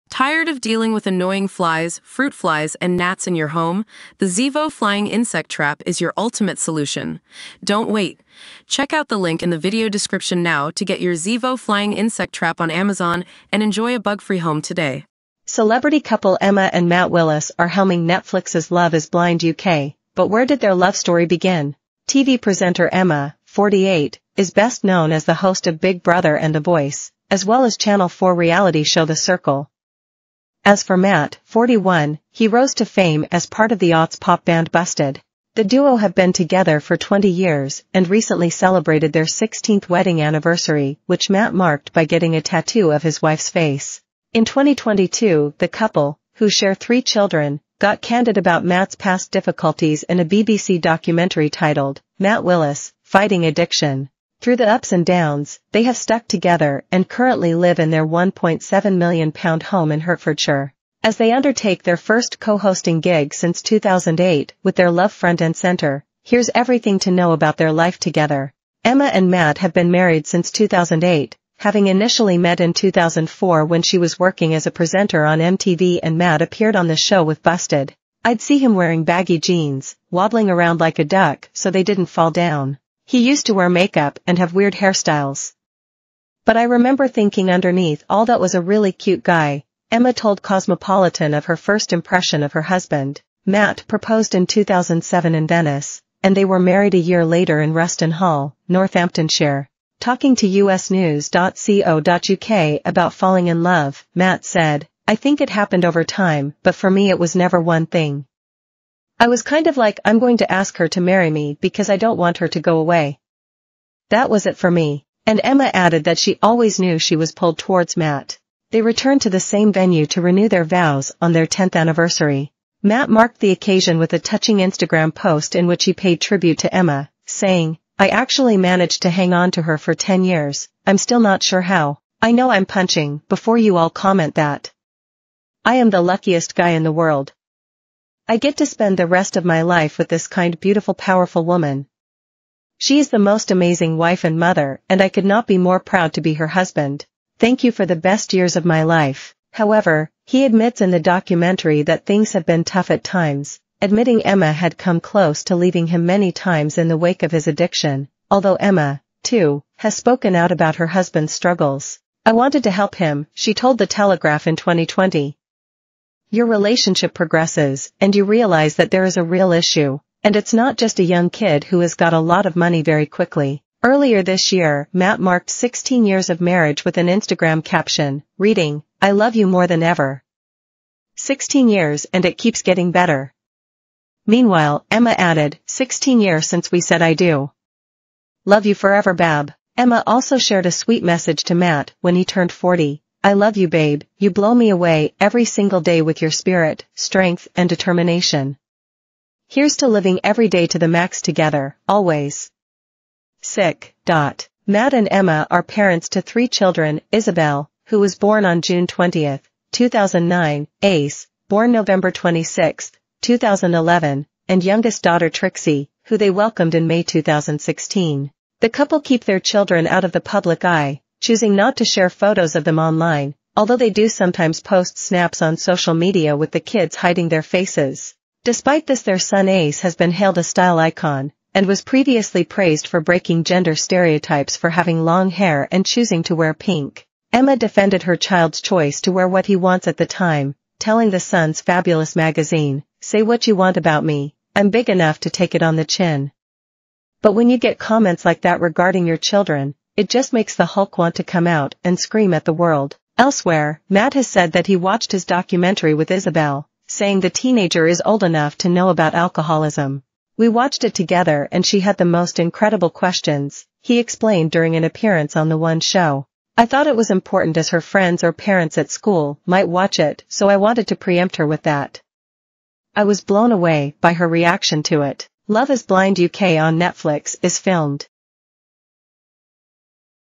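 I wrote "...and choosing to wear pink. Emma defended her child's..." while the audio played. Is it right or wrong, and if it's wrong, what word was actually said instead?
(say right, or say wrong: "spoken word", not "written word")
right.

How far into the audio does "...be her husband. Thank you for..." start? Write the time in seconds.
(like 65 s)
146 s.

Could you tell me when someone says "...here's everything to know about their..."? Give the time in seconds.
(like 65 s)
66 s.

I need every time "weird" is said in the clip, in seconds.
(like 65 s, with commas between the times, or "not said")
84 s.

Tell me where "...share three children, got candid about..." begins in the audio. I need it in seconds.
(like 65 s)
46 s.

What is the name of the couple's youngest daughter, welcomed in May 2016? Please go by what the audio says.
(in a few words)
Trixie.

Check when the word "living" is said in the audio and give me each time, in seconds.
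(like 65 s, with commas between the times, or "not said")
199 s.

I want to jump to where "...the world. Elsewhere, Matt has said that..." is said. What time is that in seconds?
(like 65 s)
252 s.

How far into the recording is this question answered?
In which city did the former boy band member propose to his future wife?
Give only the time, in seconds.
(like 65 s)
95 s.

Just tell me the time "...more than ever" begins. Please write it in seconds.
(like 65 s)
179 s.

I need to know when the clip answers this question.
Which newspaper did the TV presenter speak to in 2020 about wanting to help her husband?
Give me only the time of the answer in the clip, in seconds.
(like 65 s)
163 s.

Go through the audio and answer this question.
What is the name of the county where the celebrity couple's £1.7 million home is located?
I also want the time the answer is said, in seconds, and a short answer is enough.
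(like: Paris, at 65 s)
Hertfordshire, at 59 s.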